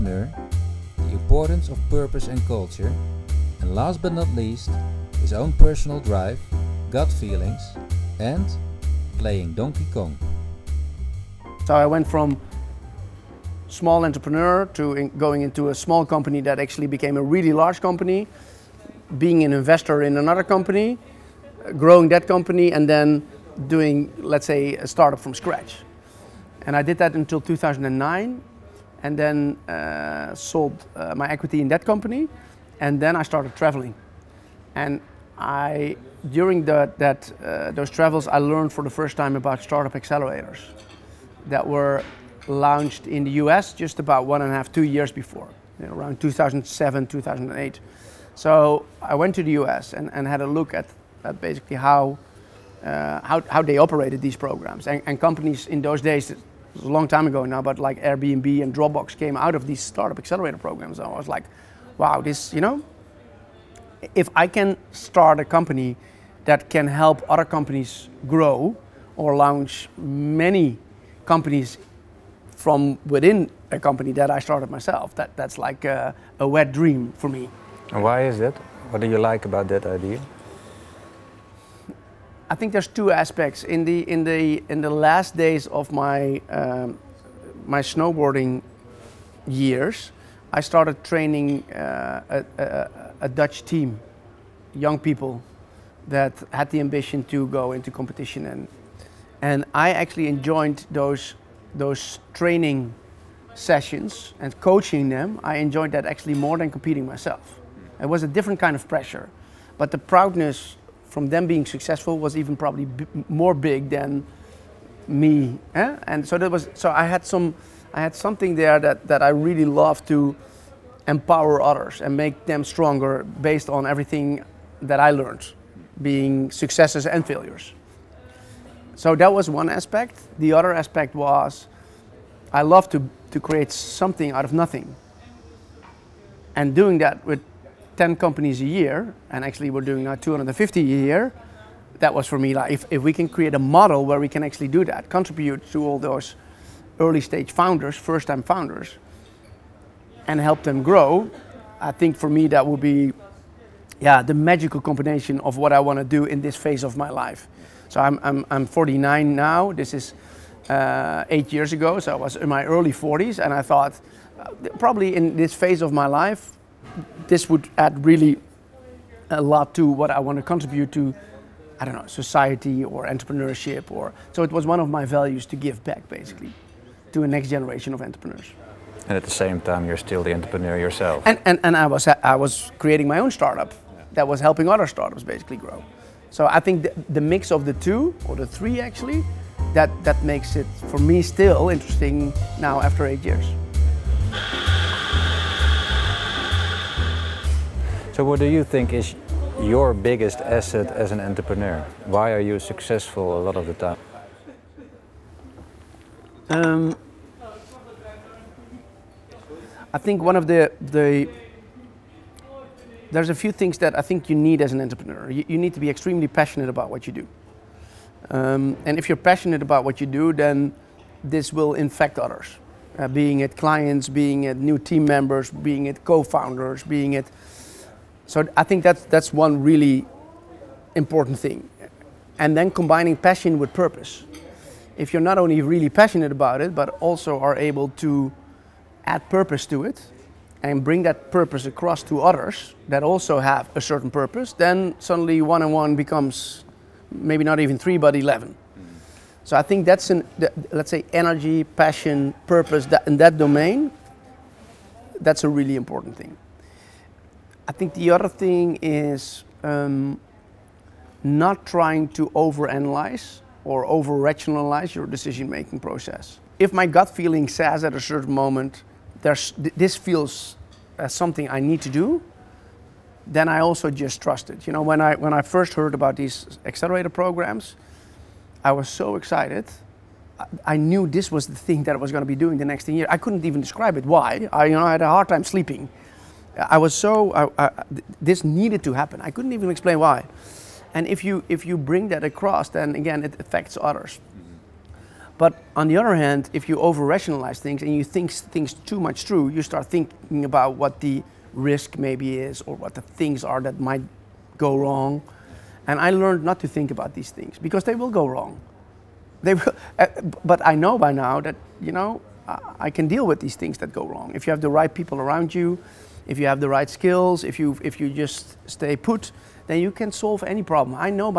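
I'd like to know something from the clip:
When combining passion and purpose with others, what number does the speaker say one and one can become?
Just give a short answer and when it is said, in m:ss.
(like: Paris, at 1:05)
11, at 4:08.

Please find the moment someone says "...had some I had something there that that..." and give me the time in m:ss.
1:57.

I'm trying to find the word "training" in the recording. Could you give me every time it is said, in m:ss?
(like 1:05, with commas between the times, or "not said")
1:31, 1:42.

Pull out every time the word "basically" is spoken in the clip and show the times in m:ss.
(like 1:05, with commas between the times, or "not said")
0:51, 2:56, 3:05.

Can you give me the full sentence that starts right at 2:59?
And at the same time, you're still the entrepreneur yourself.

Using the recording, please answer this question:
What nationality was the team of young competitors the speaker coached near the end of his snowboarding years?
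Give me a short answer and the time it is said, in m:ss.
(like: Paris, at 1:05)
Dutch, at 1:33.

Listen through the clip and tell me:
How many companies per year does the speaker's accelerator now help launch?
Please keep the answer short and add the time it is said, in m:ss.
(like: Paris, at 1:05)
250, at 2:20.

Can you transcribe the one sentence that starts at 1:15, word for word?
That, that's like a, a wet dream for me.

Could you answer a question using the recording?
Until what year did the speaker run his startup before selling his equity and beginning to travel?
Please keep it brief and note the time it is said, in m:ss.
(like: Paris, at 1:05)
2009, at 0:27.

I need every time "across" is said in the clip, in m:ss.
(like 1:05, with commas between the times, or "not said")
4:01, 4:52.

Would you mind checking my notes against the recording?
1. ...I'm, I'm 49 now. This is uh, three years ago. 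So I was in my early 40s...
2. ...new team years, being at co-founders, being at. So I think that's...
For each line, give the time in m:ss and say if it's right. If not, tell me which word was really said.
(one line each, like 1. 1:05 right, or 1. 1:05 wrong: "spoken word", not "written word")
1. 2:38 wrong: "eight", not "three"
2. 3:44 wrong: "members", not "years".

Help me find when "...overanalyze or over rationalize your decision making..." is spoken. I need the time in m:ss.
4:22.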